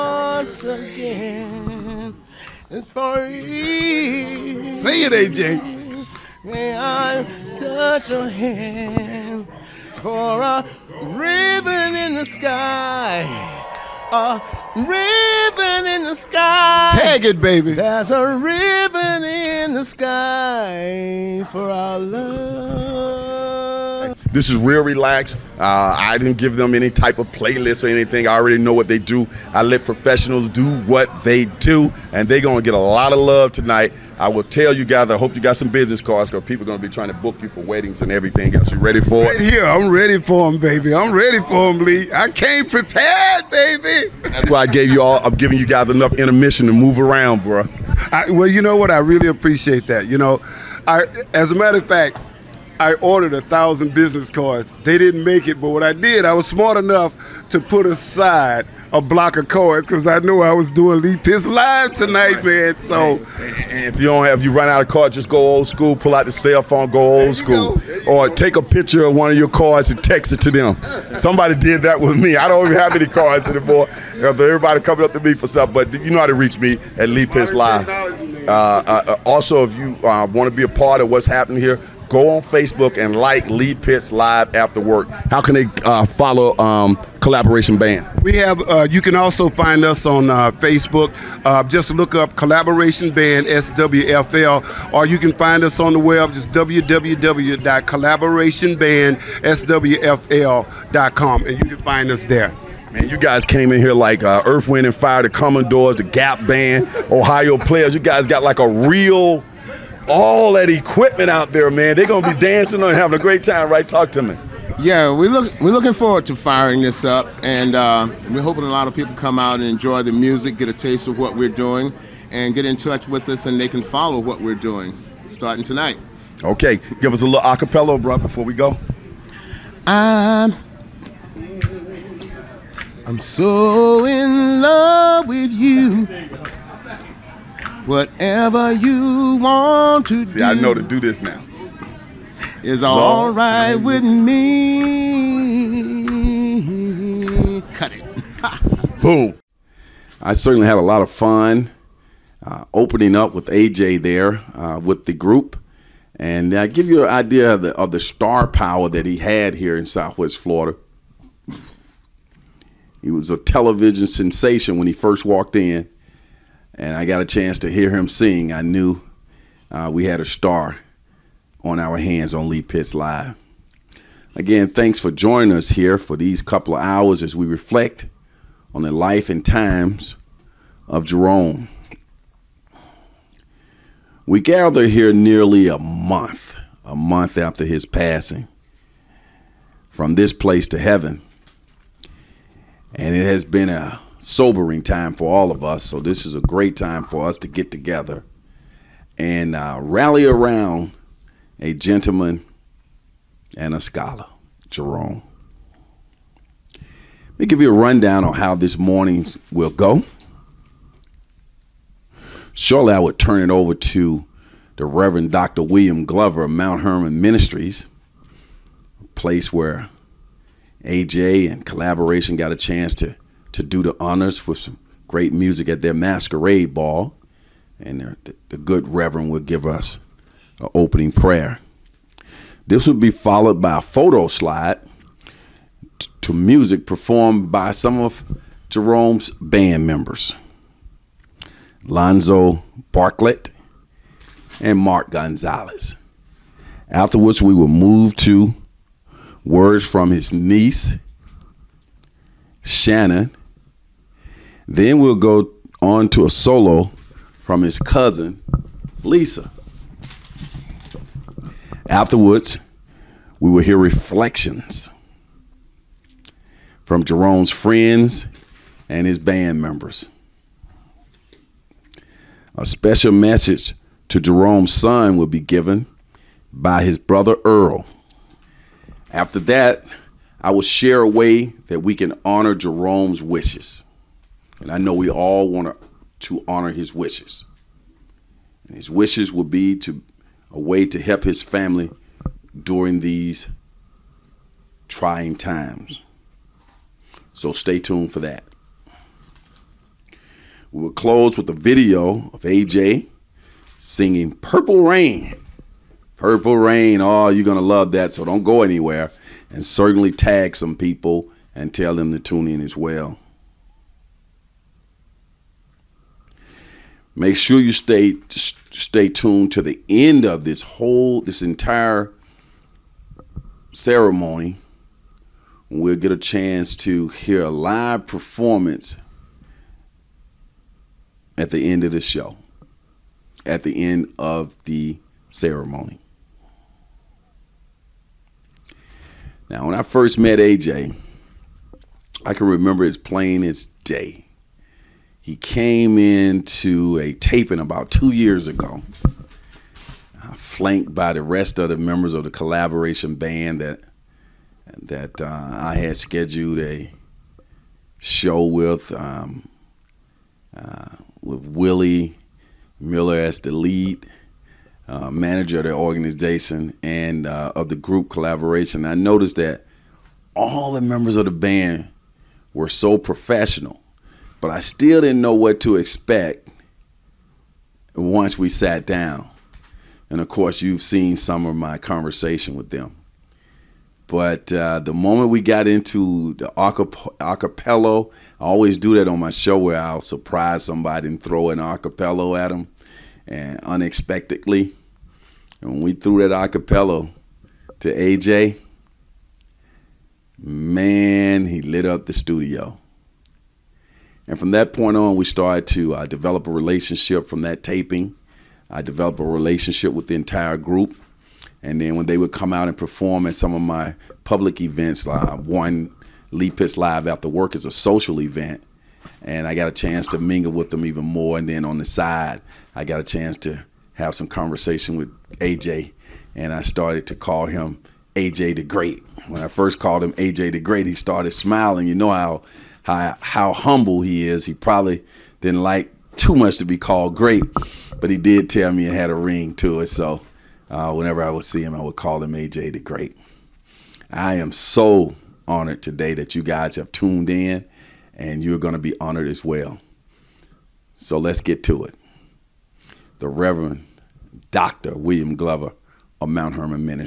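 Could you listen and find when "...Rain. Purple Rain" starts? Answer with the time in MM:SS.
05:04.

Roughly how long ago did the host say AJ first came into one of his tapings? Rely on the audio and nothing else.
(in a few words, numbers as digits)
About 2 years ago.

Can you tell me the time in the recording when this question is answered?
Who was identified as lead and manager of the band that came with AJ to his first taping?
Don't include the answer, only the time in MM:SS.
06:01.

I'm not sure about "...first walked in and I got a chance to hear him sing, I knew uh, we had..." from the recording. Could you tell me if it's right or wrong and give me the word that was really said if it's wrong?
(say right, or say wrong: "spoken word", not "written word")
right.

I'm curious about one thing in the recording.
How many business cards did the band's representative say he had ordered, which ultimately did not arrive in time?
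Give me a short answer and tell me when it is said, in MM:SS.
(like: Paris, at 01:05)
1000, at 00:53.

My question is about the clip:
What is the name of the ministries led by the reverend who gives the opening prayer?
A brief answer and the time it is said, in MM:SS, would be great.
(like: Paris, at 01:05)
Mount Hermon Ministries, at 03:36.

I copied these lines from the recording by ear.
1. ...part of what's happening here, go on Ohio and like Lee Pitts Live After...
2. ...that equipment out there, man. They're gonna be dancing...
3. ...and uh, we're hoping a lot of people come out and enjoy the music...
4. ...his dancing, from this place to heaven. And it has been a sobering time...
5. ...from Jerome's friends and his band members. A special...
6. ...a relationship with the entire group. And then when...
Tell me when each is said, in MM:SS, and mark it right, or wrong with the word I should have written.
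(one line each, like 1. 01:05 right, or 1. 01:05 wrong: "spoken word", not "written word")
1. 01:20 wrong: "Facebook", not "Ohio"
2. 01:50 right
3. 01:57 right
4. 03:07 wrong: "passing", not "dancing"
5. 04:26 right
6. 06:49 right.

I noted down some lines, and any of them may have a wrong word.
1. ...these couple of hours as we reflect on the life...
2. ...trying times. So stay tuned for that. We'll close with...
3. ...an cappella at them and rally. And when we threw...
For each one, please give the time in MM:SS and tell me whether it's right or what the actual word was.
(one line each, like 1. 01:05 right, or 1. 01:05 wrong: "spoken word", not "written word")
1. 02:56 right
2. 04:54 right
3. 06:31 wrong: "unexpectedly", not "rally".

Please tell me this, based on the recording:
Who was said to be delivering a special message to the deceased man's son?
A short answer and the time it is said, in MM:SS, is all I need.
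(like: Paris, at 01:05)
Earl, at 04:37.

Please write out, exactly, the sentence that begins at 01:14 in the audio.
Everybody coming up to me for stuff, but you know how to reach me at Lee Pitts Live.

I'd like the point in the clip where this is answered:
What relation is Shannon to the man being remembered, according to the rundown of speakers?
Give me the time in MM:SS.
04:10.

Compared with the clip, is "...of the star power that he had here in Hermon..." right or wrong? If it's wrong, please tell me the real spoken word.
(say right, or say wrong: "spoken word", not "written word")
wrong: "Southwest", not "Hermon".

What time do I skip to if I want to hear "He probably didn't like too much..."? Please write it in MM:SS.
07:14.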